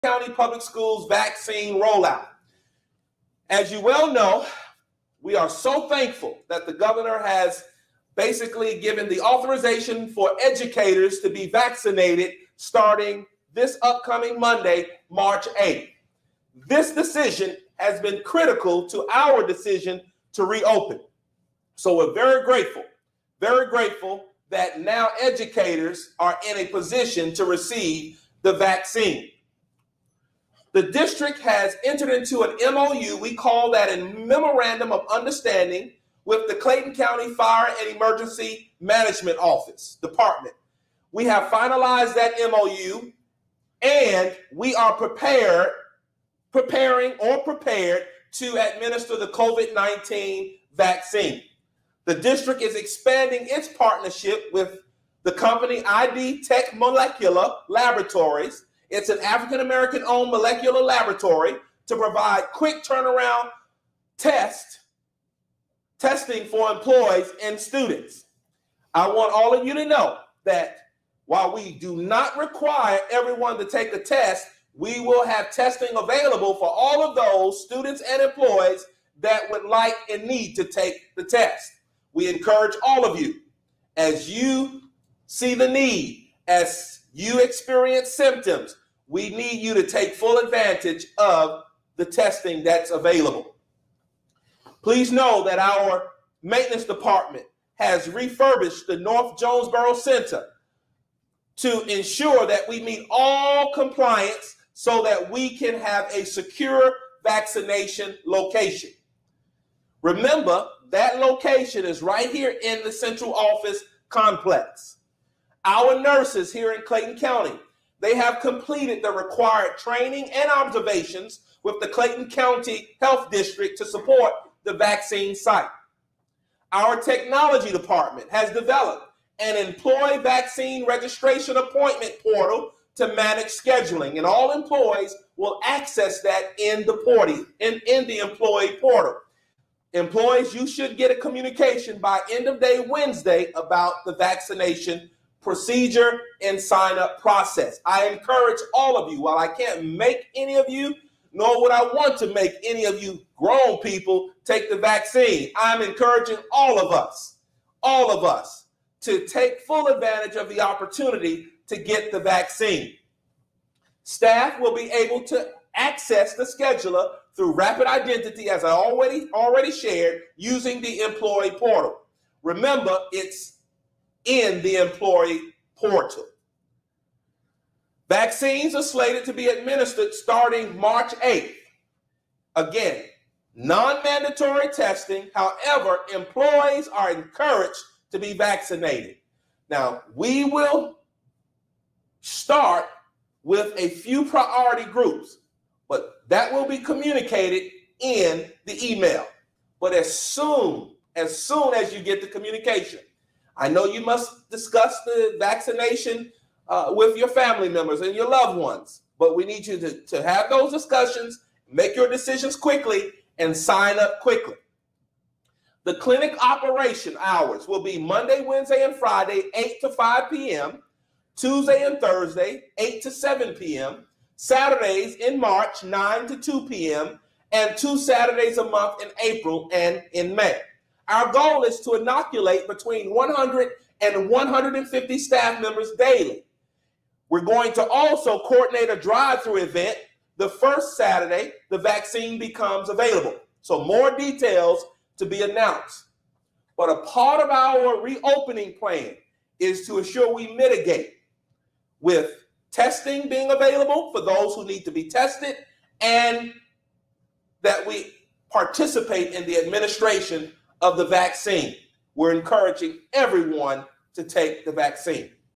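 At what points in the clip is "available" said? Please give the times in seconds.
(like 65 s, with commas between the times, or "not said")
75 s, 92 s, 242 s, 253 s.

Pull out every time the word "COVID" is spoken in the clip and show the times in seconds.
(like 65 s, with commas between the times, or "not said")
49 s.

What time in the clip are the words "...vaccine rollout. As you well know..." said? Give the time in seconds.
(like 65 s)
1 s.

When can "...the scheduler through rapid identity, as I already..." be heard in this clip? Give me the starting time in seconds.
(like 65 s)
166 s.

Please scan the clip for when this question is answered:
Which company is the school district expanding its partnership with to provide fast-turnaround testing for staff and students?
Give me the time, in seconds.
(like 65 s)
55 s.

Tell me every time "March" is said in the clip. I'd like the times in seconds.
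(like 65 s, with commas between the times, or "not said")
15 s, 180 s, 225 s.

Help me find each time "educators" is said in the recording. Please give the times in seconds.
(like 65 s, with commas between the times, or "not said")
10 s, 25 s.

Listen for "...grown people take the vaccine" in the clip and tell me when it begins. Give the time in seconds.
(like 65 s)
153 s.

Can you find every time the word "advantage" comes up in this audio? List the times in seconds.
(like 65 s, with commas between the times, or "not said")
90 s, 159 s.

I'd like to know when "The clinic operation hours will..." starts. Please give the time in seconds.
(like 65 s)
215 s.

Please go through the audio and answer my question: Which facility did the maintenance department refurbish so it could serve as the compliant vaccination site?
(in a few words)
North Jonesboro Center.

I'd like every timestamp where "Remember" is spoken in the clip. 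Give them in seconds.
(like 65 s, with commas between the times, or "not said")
110 s, 172 s.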